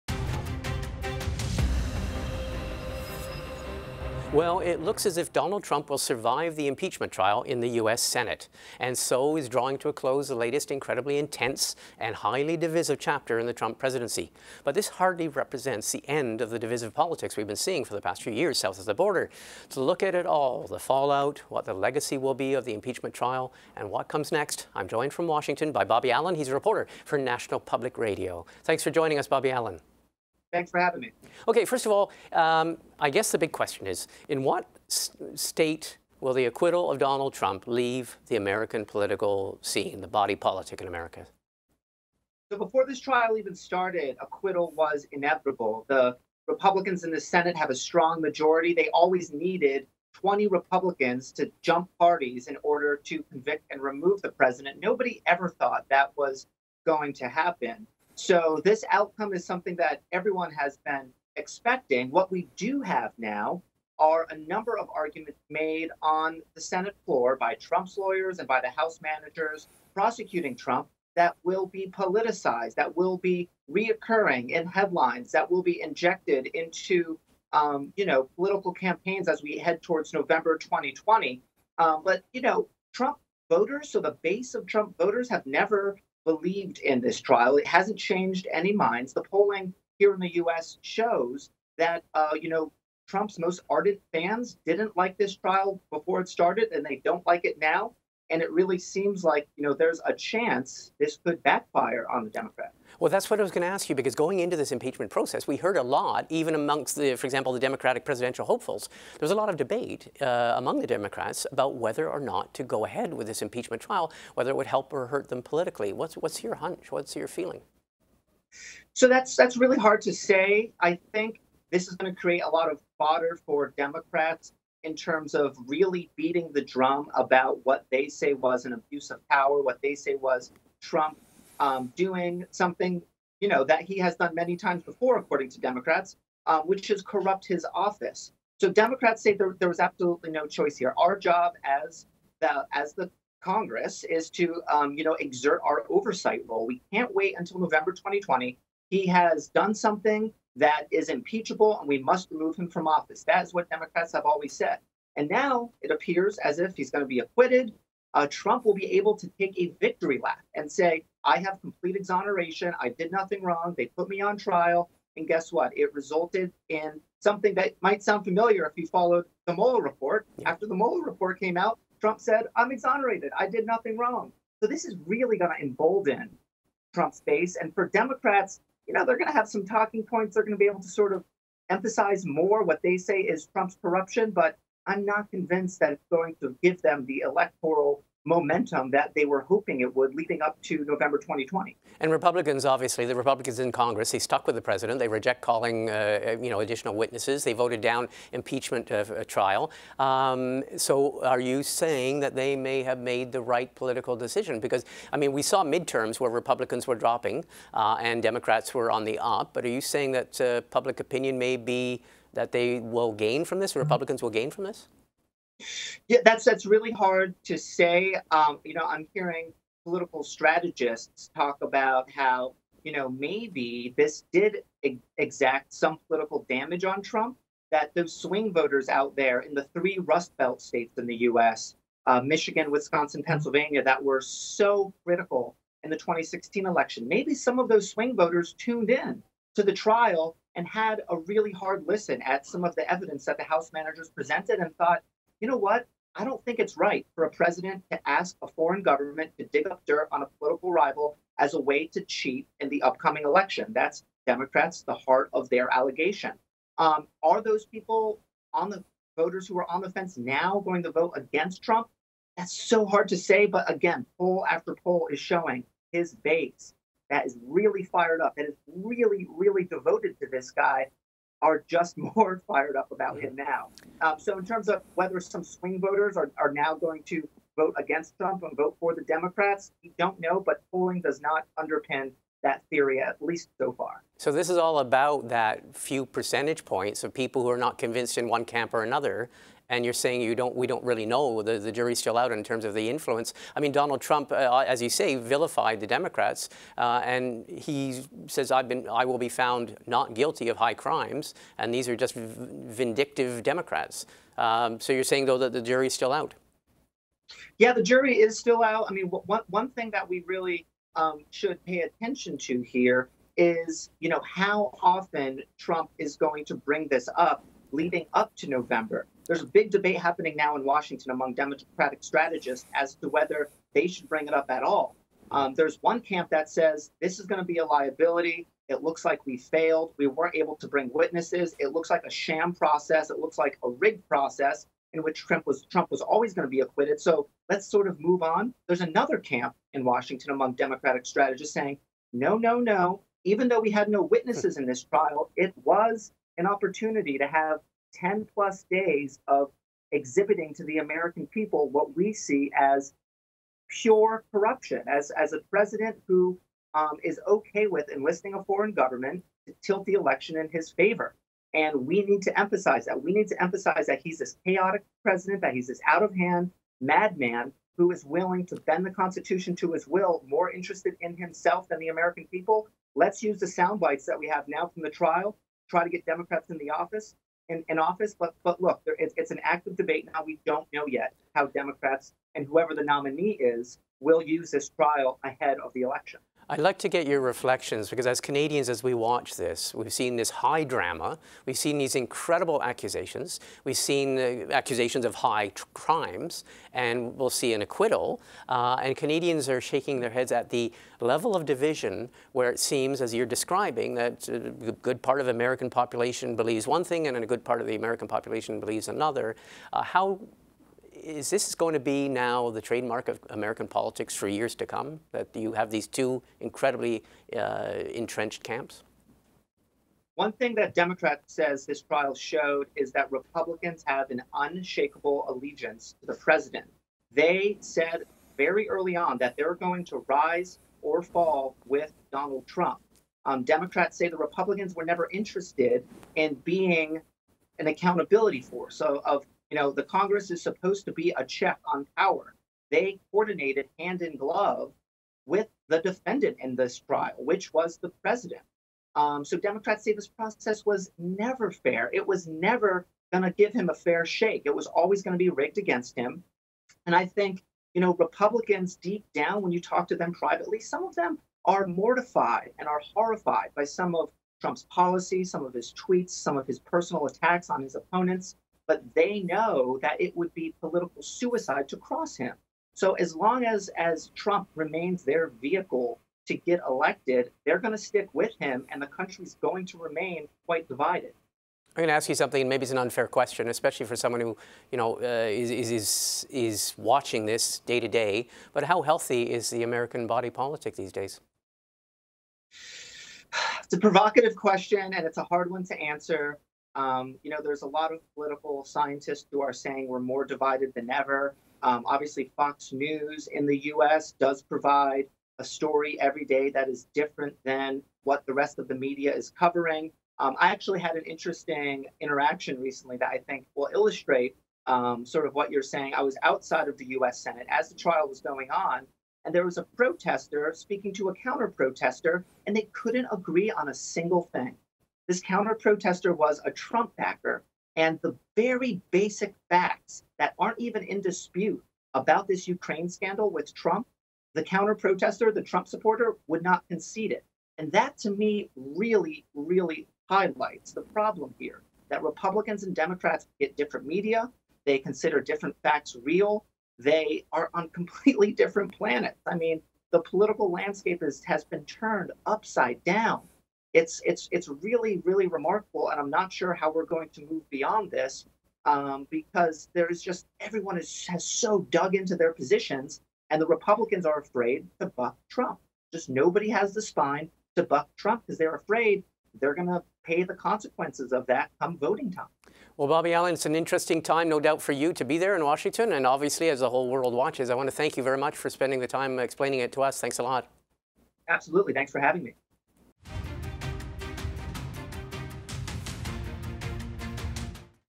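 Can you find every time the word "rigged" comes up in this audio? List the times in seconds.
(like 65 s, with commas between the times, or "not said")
333 s, 455 s.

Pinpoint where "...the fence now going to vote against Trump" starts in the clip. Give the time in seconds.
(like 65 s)
259 s.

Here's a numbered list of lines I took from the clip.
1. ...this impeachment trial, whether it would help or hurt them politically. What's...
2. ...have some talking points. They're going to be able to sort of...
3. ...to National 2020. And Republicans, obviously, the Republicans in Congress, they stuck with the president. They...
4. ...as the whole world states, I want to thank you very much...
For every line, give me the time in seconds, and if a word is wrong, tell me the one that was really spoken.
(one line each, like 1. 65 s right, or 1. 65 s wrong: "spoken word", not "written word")
1. 113 s right
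2. 179 s right
3. 190 s wrong: "November", not "National"
4. 576 s wrong: "watches", not "states".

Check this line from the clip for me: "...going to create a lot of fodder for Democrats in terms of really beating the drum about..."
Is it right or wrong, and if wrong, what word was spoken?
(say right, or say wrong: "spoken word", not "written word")
right.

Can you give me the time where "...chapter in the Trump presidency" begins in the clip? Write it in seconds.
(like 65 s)
12 s.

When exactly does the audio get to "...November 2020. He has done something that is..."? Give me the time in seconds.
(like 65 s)
147 s.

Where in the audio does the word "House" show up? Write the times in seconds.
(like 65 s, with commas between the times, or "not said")
68 s, 243 s.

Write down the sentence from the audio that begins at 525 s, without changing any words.
This counter protester was a Trump backer.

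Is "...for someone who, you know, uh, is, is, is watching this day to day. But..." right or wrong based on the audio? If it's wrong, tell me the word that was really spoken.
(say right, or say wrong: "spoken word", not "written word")
right.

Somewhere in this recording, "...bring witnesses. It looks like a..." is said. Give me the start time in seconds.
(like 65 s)
330 s.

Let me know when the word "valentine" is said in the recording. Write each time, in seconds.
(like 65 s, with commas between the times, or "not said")
not said.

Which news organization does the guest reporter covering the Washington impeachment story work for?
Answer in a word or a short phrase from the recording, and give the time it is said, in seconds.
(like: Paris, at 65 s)
National Public Radio, at 27 s.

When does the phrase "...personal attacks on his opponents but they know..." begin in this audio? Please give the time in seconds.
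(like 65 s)
466 s.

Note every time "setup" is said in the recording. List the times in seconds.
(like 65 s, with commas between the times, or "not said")
not said.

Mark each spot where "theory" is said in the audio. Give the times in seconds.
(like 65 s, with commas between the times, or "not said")
282 s.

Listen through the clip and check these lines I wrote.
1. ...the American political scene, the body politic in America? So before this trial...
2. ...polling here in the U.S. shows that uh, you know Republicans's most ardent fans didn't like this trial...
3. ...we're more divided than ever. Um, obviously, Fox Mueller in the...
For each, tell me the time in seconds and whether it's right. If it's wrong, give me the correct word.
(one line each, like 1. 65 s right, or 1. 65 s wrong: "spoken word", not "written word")
1. 38 s right
2. 89 s wrong: "Trump", not "Republicans"
3. 499 s wrong: "News", not "Mueller".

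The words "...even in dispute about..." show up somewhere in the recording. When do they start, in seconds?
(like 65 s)
530 s.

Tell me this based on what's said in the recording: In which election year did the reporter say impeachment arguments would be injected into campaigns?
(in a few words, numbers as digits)
2016.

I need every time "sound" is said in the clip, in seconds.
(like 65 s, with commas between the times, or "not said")
168 s, 373 s.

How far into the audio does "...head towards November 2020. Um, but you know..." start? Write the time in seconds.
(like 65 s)
79 s.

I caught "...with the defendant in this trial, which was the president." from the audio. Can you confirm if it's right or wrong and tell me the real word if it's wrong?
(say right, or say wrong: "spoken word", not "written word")
right.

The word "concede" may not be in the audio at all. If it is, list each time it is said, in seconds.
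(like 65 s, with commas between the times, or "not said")
536 s.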